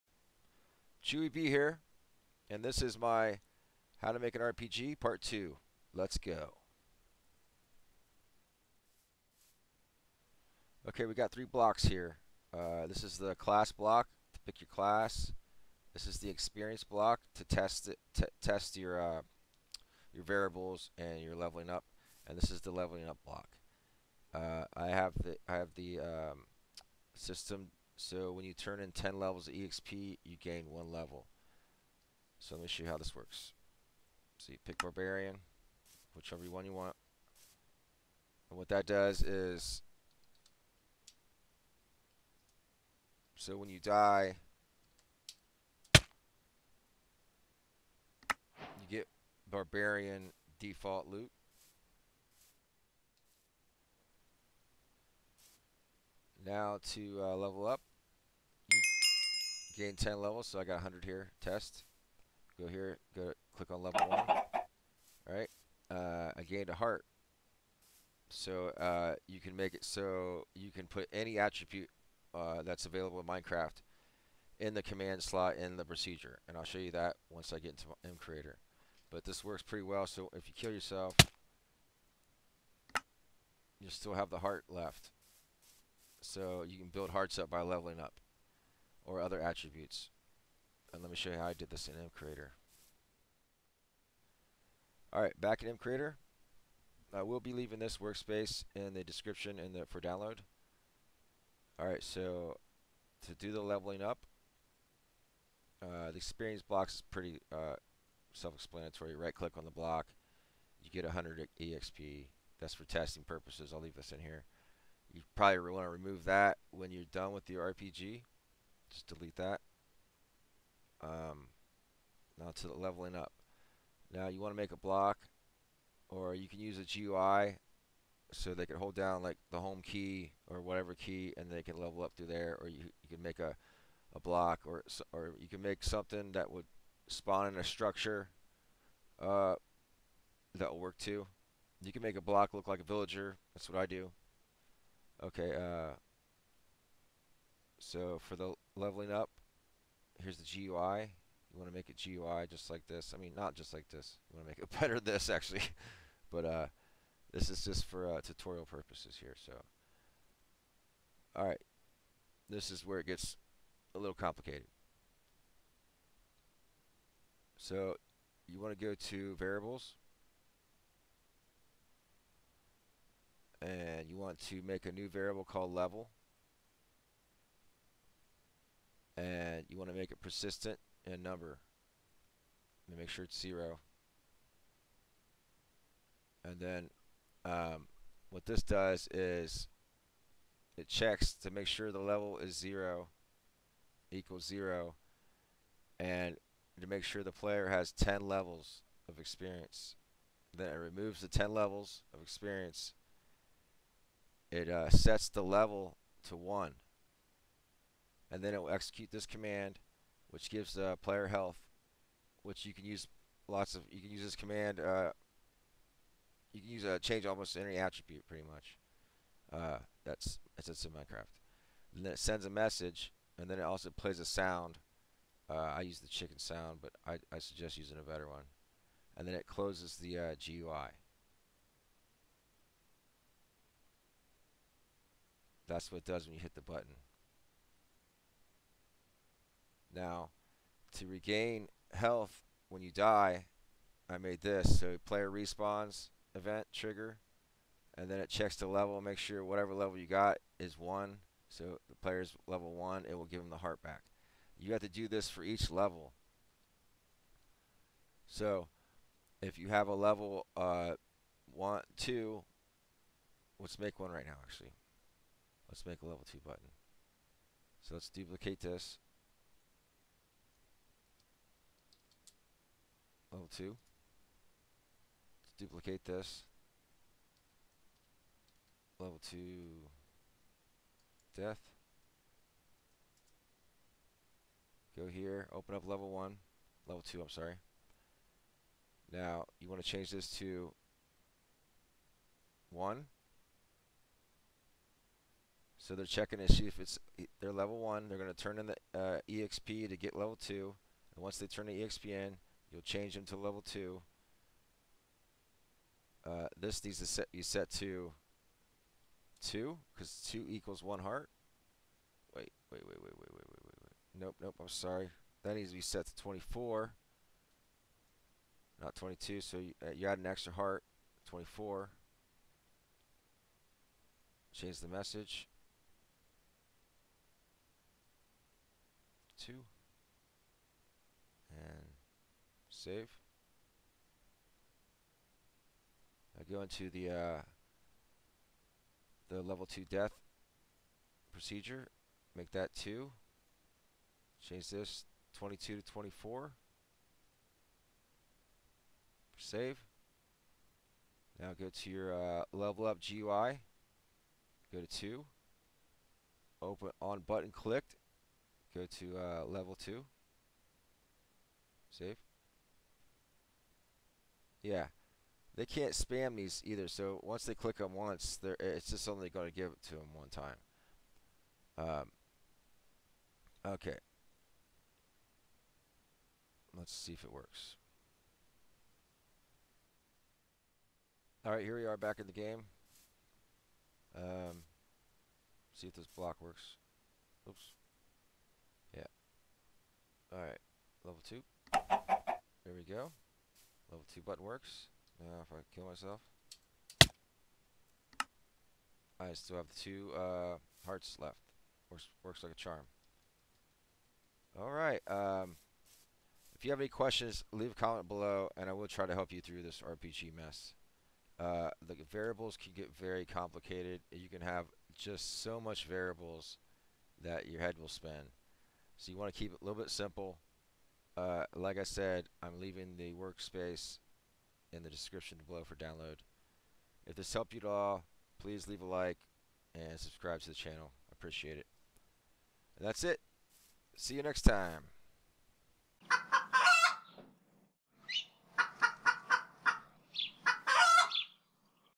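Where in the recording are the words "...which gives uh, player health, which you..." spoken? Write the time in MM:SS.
03:30.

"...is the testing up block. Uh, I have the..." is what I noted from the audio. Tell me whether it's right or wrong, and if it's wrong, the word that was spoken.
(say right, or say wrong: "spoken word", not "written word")
wrong: "leveling", not "testing".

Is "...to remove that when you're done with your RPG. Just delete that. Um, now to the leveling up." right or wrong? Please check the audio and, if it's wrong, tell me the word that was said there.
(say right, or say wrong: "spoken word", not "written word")
right.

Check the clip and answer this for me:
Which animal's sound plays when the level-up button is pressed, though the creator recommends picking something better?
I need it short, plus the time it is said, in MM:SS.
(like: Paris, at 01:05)
chicken, at 03:46.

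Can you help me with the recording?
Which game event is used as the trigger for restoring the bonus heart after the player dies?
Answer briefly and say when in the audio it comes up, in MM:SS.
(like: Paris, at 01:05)
player respawns, at 04:05.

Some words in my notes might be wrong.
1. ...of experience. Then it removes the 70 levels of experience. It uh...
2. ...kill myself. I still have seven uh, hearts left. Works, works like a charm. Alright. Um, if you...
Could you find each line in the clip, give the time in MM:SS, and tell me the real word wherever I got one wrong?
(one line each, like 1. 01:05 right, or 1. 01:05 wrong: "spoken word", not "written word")
1. 03:19 wrong: "10", not "70"
2. 06:35 wrong: "two", not "seven".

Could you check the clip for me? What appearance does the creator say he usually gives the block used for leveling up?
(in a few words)
a villager.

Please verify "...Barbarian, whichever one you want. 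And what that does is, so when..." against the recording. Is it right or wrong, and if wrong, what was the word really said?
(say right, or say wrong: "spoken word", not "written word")
right.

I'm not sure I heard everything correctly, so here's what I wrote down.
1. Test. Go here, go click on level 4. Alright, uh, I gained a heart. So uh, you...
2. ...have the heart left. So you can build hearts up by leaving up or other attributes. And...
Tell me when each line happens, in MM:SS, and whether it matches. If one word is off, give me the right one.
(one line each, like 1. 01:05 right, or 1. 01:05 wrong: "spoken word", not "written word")
1. 01:01 wrong: "1", not "4"
2. 01:24 wrong: "leveling", not "leaving".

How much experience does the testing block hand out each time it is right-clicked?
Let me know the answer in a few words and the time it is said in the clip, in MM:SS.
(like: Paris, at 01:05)
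100 EXP, at 01:51.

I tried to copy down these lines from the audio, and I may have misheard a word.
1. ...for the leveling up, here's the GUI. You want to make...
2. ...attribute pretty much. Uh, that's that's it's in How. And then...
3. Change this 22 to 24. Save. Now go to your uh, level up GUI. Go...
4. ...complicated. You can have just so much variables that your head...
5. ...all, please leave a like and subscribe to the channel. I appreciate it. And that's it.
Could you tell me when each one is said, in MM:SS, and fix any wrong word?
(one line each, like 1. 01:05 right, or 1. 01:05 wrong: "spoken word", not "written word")
1. 02:28 right
2. 03:37 wrong: "Minecraft", not "How"
3. 05:44 right
4. 06:53 right
5. 07:07 right.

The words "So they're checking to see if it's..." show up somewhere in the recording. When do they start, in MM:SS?
04:55.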